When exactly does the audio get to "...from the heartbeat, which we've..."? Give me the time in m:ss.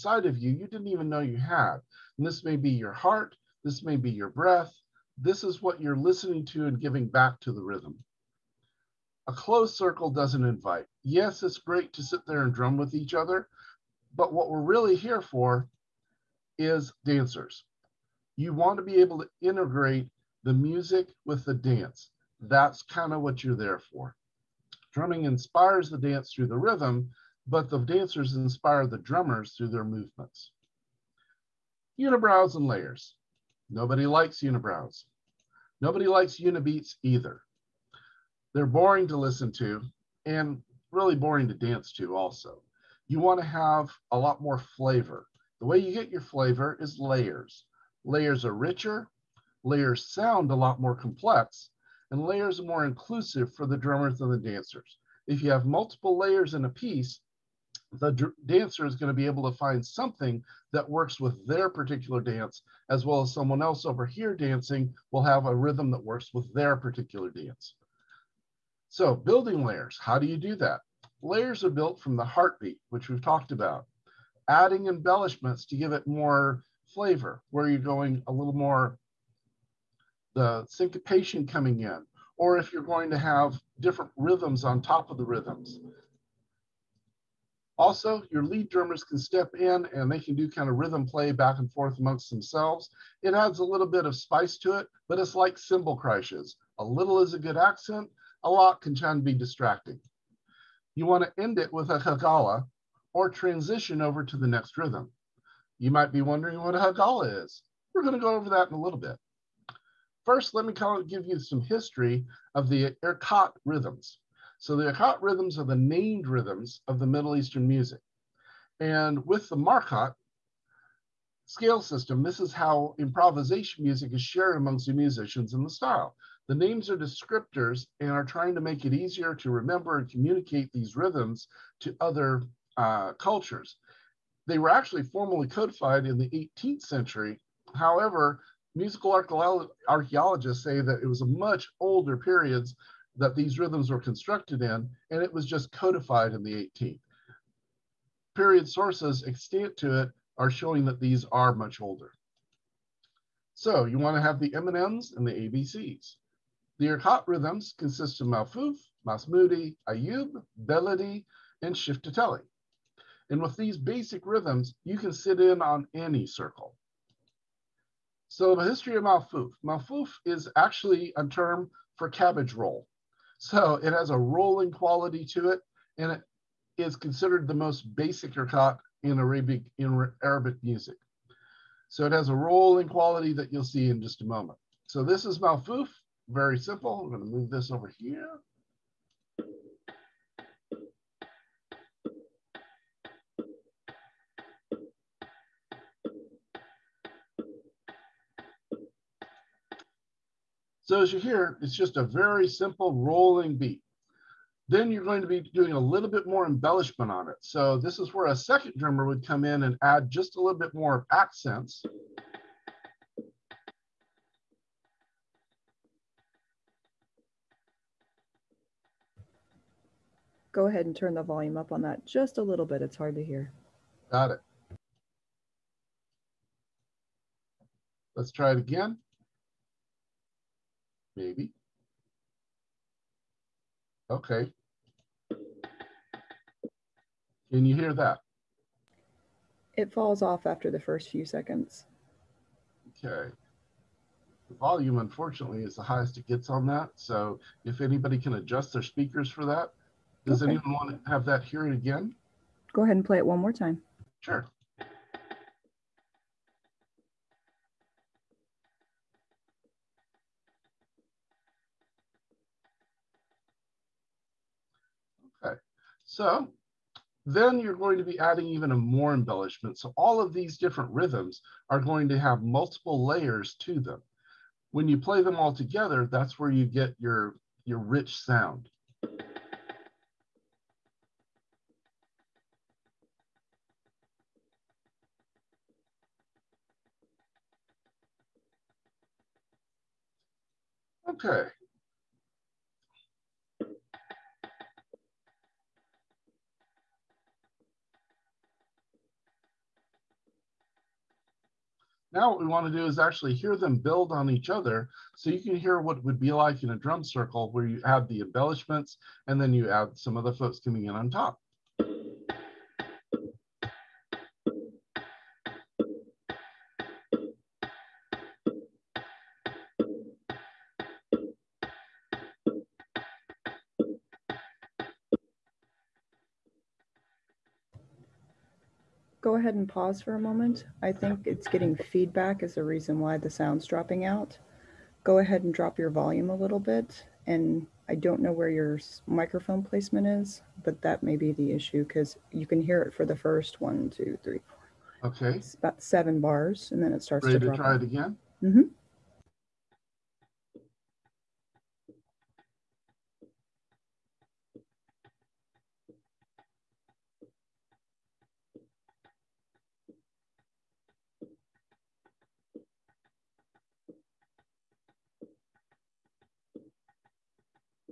1:12.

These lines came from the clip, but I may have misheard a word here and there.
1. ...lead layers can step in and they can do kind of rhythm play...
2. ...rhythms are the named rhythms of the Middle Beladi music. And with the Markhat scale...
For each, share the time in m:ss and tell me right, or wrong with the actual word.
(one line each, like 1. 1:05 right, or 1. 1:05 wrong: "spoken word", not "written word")
1. 1:28 wrong: "drummers", not "layers"
2. 1:55 wrong: "Eastern", not "Beladi".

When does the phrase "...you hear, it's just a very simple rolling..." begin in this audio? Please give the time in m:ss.
3:21.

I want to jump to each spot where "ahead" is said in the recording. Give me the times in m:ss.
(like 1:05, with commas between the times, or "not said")
3:40, 4:12, 5:29, 5:35.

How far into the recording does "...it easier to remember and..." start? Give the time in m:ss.
2:08.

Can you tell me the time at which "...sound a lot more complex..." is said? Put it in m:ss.
0:50.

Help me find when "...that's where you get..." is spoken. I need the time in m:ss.
4:36.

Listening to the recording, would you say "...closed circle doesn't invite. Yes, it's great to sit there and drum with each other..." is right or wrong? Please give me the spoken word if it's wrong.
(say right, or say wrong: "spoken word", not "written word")
right.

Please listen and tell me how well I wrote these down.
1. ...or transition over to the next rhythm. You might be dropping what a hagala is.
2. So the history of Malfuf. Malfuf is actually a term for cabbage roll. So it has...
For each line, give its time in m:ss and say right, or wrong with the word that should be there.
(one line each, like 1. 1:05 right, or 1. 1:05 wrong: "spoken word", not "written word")
1. 1:43 wrong: "wondering", not "dropping"
2. 2:48 right.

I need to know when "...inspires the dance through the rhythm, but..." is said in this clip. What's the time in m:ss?
0:25.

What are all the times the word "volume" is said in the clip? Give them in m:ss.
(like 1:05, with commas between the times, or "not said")
3:41, 4:04, 5:35.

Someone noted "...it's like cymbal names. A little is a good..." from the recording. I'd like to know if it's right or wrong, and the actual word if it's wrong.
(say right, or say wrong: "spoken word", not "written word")
wrong: "crashes", not "names".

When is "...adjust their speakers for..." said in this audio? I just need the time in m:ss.
4:08.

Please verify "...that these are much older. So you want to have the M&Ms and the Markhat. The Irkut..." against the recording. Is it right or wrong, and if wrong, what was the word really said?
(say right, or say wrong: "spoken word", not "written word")
wrong: "ABCs", not "Markhat".